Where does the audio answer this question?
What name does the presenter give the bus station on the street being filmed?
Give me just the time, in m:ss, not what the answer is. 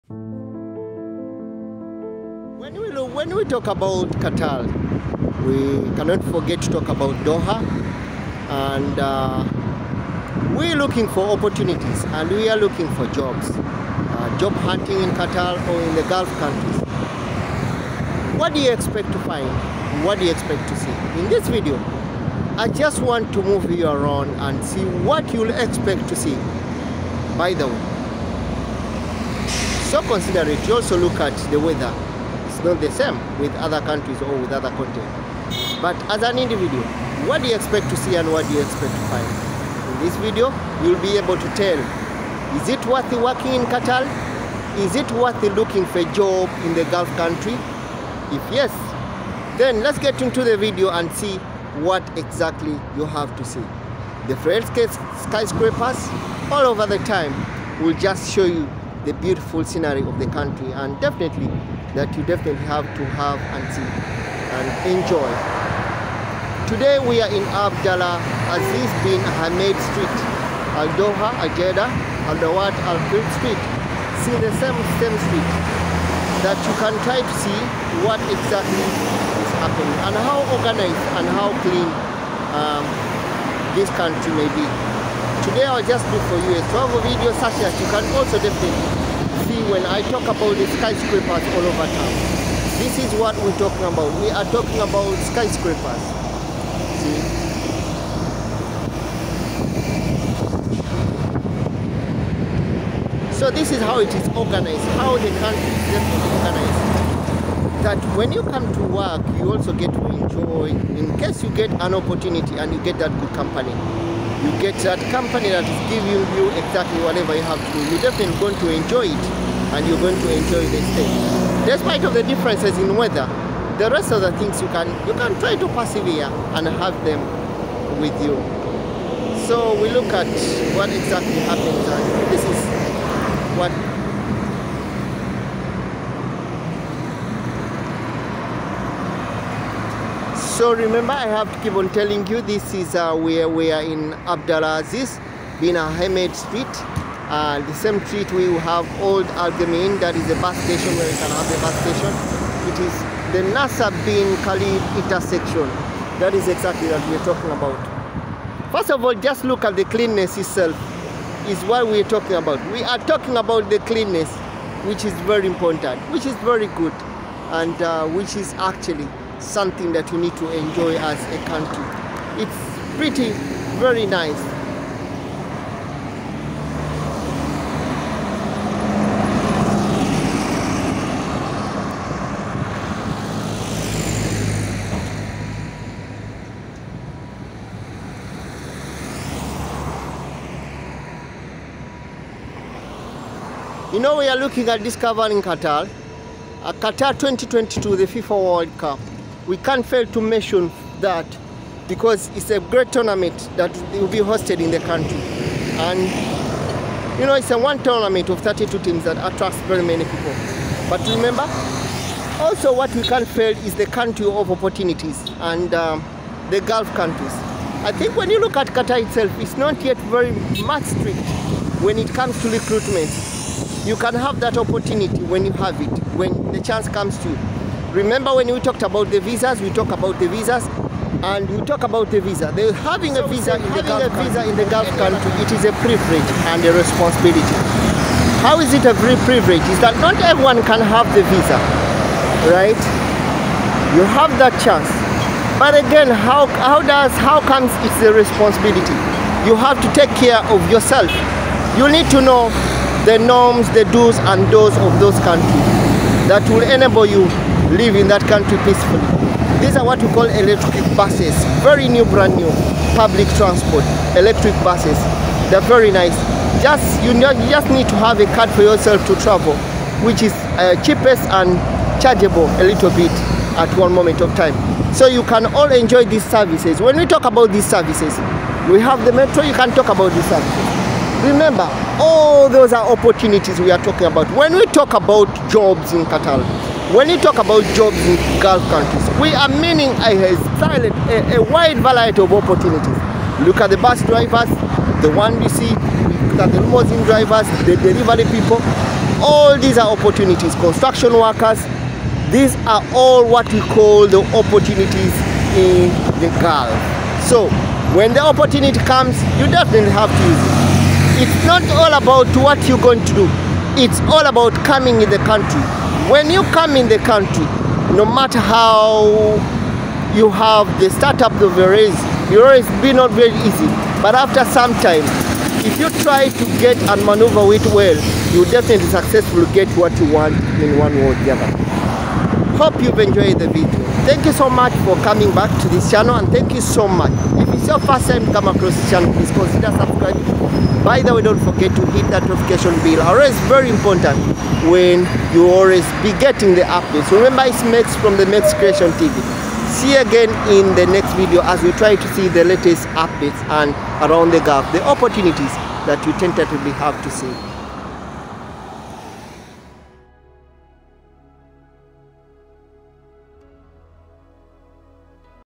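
2:29.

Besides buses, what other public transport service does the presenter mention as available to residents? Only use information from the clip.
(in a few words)
Metro.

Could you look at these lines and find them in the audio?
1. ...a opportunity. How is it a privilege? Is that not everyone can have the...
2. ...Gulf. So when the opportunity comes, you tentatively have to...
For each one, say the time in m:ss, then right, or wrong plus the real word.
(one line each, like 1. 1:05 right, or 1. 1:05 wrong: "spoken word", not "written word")
1. 3:56 wrong: "responsibility", not "opportunity"
2. 5:06 wrong: "definitely", not "tentatively".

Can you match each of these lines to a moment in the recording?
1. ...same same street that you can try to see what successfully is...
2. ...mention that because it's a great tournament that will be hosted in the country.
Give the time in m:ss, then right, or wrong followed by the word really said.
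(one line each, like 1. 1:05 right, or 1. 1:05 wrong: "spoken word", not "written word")
1. 1:14 wrong: "exactly", not "successfully"
2. 3:20 right.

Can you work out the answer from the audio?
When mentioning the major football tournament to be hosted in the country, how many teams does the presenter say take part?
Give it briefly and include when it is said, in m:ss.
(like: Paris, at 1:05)
32, at 3:28.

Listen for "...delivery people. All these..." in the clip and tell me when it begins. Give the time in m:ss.
4:57.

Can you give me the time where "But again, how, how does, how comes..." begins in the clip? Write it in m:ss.
4:05.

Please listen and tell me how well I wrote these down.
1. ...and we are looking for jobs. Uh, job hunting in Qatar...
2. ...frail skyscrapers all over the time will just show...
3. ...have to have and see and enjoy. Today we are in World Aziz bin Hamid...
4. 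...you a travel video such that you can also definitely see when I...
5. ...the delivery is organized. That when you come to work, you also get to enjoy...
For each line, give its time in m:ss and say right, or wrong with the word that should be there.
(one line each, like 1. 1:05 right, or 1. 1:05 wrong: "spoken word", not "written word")
1. 0:12 right
2. 0:54 right
3. 1:02 wrong: "Abdallah", not "World"
4. 1:26 right
5. 1:45 wrong: "country", not "delivery".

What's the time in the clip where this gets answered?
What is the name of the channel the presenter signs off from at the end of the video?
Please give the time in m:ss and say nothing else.
5:48.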